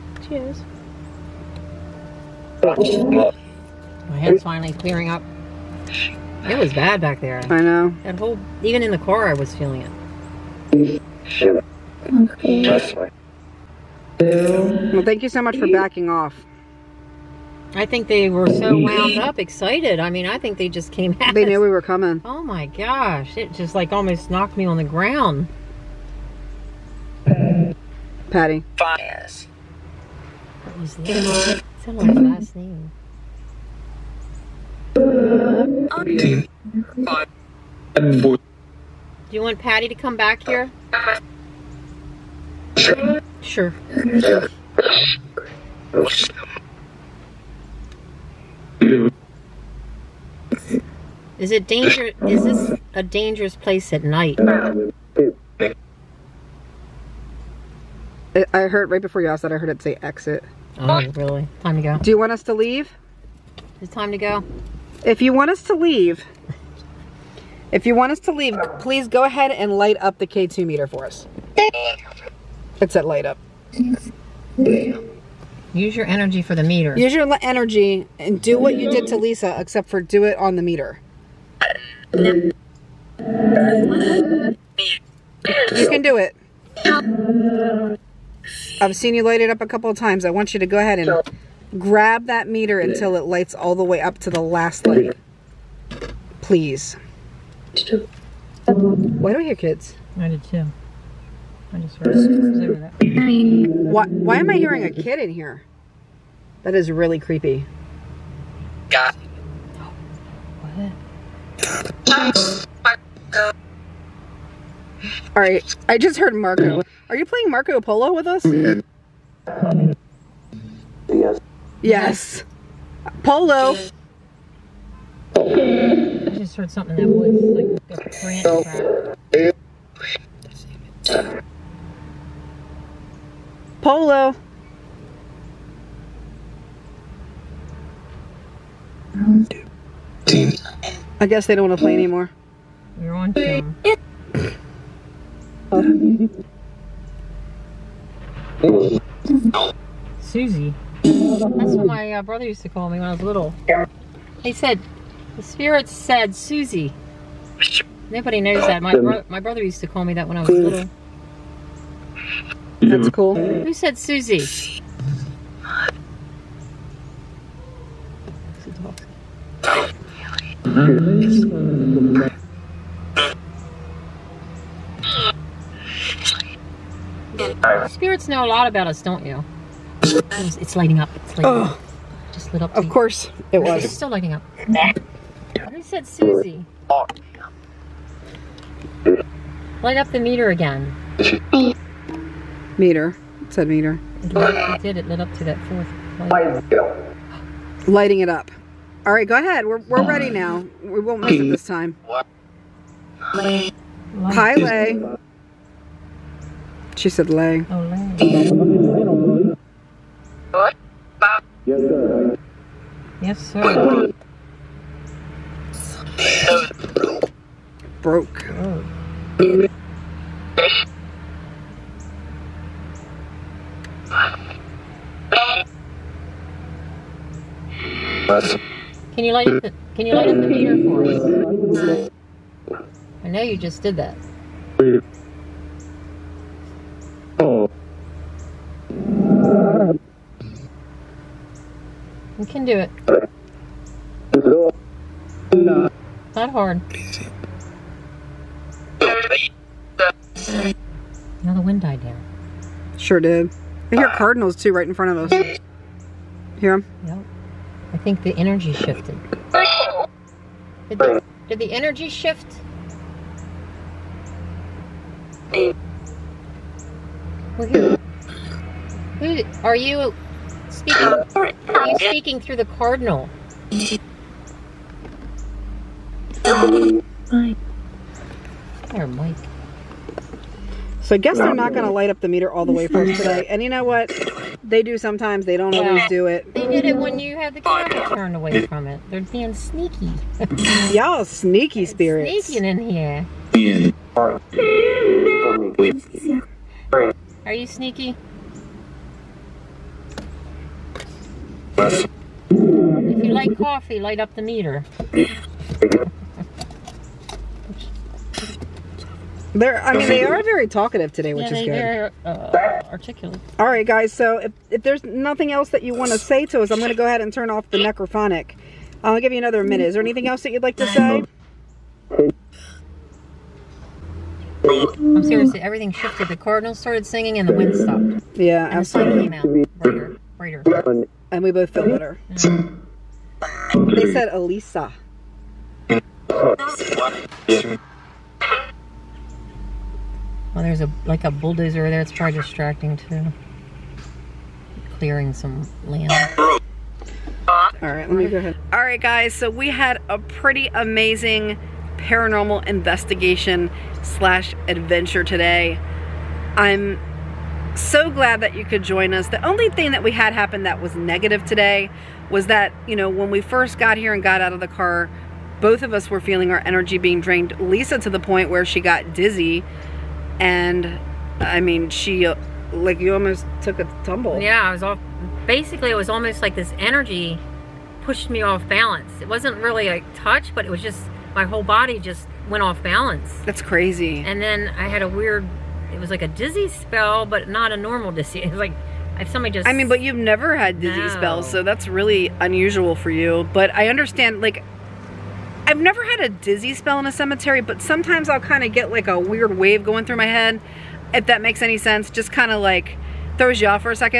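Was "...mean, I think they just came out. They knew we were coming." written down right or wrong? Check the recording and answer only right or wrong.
right.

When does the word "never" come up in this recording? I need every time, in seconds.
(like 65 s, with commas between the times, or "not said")
390 s, 395 s.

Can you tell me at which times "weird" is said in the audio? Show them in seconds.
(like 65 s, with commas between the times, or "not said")
385 s, 399 s.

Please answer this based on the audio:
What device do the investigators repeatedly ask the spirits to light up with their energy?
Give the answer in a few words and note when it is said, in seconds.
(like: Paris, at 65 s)
K2 meter, at 70 s.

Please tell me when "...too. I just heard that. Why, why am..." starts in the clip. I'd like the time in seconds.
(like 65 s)
100 s.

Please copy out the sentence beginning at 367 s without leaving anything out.
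Lisa to the point where she got dizzy and I mean, she uh, like you almost took a tumble.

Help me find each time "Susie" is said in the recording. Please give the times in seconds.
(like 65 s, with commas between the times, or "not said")
150 s, 156 s, 163 s, 186 s.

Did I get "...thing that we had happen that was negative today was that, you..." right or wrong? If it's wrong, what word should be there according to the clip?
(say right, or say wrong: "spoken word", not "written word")
right.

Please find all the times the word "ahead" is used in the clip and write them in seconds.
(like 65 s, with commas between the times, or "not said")
69 s, 90 s, 199 s, 317 s, 348 s.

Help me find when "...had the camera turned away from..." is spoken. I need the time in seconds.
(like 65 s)
287 s.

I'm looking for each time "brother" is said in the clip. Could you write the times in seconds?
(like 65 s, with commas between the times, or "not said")
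152 s, 159 s.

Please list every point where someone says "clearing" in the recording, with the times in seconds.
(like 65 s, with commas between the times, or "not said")
4 s, 344 s.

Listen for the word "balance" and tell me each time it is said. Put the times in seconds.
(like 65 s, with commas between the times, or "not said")
378 s, 382 s.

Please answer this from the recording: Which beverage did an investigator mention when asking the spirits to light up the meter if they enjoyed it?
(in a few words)
Coffee.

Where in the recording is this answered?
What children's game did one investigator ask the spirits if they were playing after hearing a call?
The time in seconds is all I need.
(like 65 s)
117 s.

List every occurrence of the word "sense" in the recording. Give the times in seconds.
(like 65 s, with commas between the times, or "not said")
401 s.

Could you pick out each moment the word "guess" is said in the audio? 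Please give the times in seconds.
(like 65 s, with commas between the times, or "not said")
141 s, 281 s.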